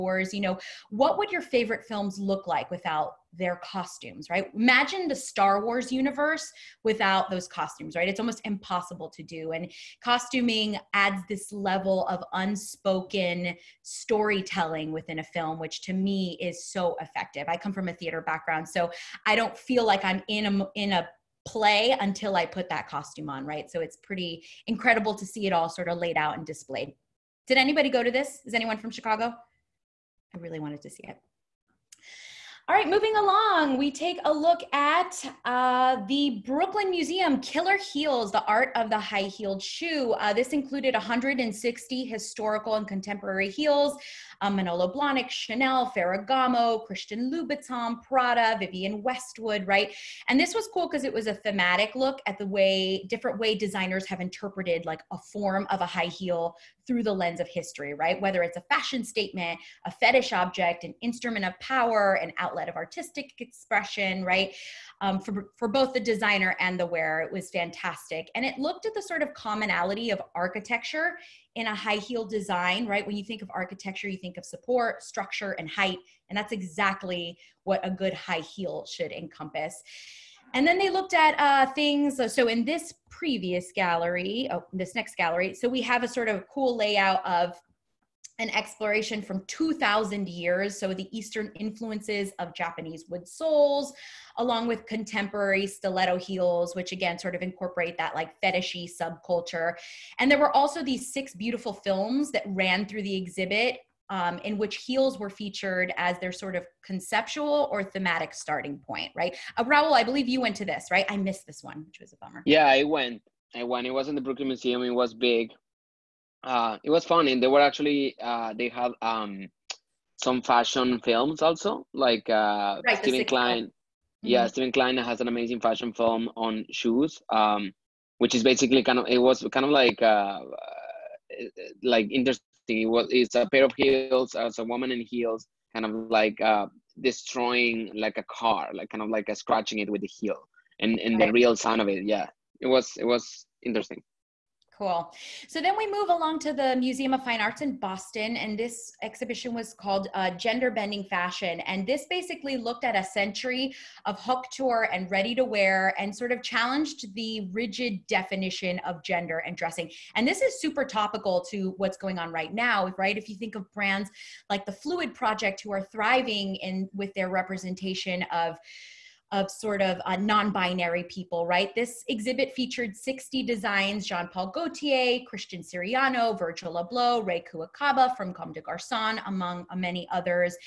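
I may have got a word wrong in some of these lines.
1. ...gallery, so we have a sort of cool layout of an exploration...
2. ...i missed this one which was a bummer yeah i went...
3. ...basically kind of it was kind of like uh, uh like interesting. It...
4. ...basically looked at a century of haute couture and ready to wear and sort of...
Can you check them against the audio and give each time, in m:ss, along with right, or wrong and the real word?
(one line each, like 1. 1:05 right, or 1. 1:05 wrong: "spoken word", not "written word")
1. 1:25 right
2. 1:51 right
3. 2:08 right
4. 2:32 right.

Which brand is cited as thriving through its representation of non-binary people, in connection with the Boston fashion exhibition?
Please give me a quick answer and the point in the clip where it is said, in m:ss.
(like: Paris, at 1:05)
The Phluid Project, at 2:44.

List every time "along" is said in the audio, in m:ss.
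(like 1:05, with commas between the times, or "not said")
0:33, 1:34, 2:26.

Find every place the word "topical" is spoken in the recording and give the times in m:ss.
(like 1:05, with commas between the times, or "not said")
2:40.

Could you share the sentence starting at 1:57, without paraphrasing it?
they were actually uh, they had um, some fashion films also, like uh, right, Steven Klein.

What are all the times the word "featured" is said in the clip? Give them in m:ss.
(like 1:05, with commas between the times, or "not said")
1:45, 2:52.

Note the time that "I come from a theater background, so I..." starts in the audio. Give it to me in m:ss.
0:17.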